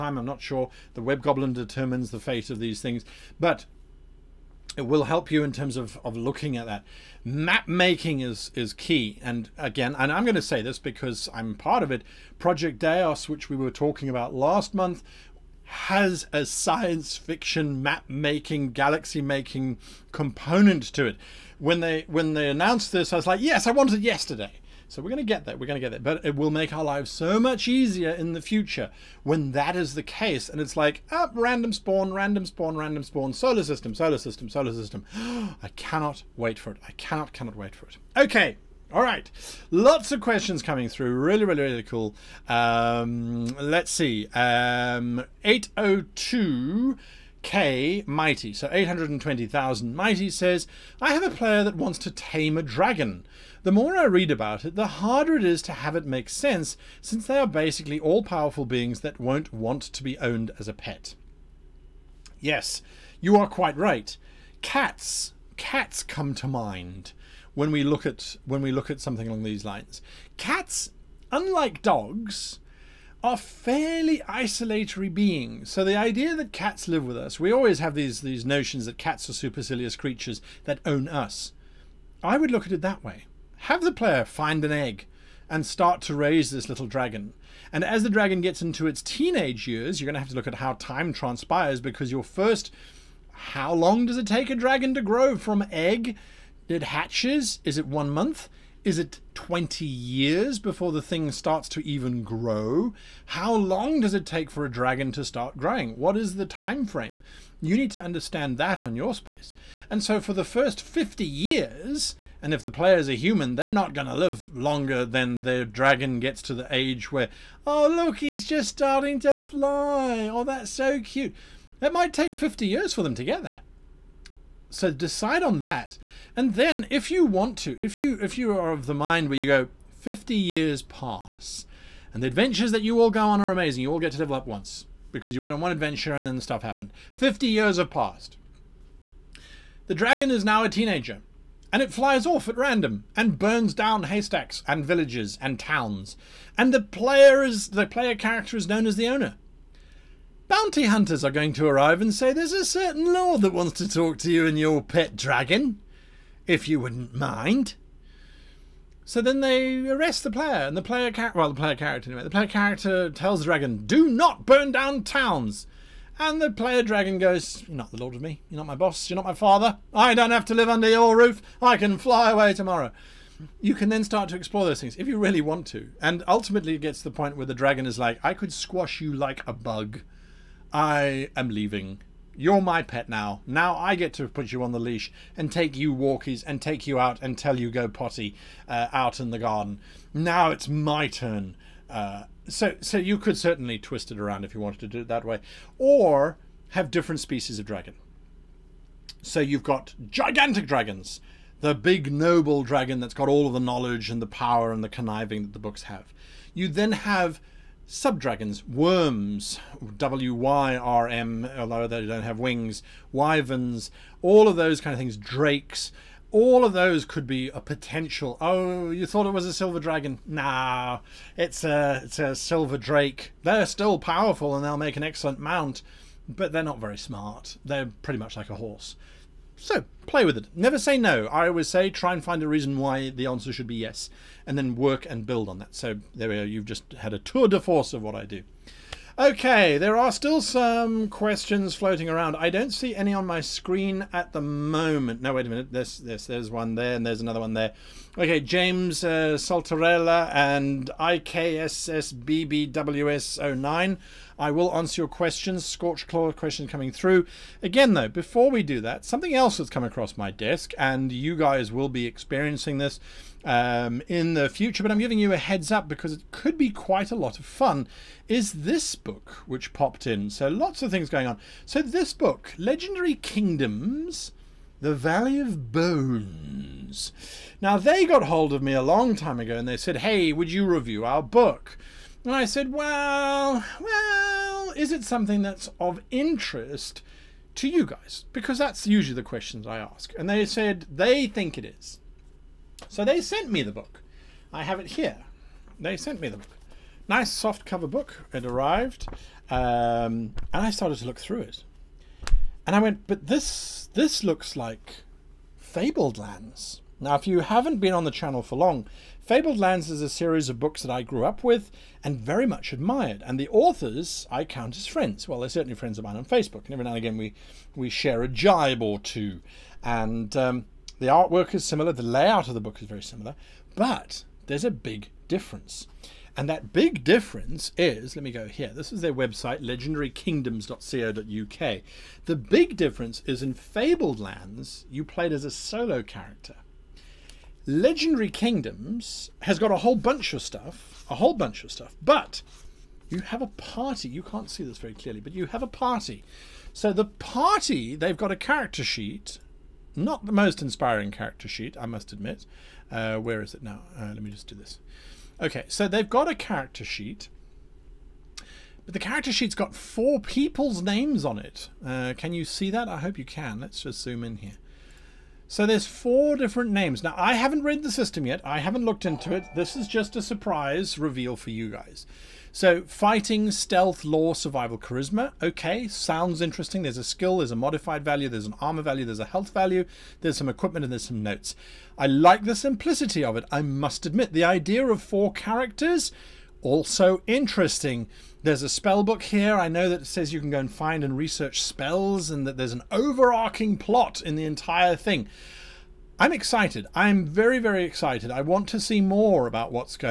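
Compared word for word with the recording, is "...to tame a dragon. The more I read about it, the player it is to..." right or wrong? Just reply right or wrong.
wrong.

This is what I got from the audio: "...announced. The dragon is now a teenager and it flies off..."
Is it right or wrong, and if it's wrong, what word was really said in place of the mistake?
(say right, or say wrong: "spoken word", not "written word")
wrong: "passed", not "announced".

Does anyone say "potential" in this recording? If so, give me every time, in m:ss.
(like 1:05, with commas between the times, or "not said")
3:37.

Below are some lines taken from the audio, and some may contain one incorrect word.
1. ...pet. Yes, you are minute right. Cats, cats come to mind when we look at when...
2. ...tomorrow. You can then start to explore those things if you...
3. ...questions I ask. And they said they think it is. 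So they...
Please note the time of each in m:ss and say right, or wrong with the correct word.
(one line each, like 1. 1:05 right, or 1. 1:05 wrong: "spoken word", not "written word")
1. 1:00 wrong: "quite", not "minute"
2. 2:52 right
3. 4:49 right.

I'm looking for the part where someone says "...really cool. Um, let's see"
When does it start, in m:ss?
0:41.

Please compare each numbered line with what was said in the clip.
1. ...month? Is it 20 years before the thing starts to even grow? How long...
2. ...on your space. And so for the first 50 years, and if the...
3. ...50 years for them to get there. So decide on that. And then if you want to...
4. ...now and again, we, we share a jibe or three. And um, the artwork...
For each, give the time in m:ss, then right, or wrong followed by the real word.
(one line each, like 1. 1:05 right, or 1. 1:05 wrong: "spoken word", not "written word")
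1. 1:38 right
2. 1:48 right
3. 2:02 right
4. 5:16 wrong: "two", not "three".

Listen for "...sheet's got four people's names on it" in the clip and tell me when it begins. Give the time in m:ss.
5:59.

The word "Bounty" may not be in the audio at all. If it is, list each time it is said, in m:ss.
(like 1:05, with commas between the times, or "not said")
2:30.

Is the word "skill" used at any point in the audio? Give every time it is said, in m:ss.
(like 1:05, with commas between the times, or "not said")
6:17.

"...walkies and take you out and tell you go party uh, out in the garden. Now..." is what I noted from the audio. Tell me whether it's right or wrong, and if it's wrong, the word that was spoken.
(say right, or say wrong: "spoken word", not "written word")
wrong: "potty", not "party".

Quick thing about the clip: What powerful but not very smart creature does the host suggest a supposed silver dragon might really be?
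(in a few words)
Silver drake.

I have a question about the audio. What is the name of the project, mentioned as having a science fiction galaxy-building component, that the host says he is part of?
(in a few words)
Project Deios.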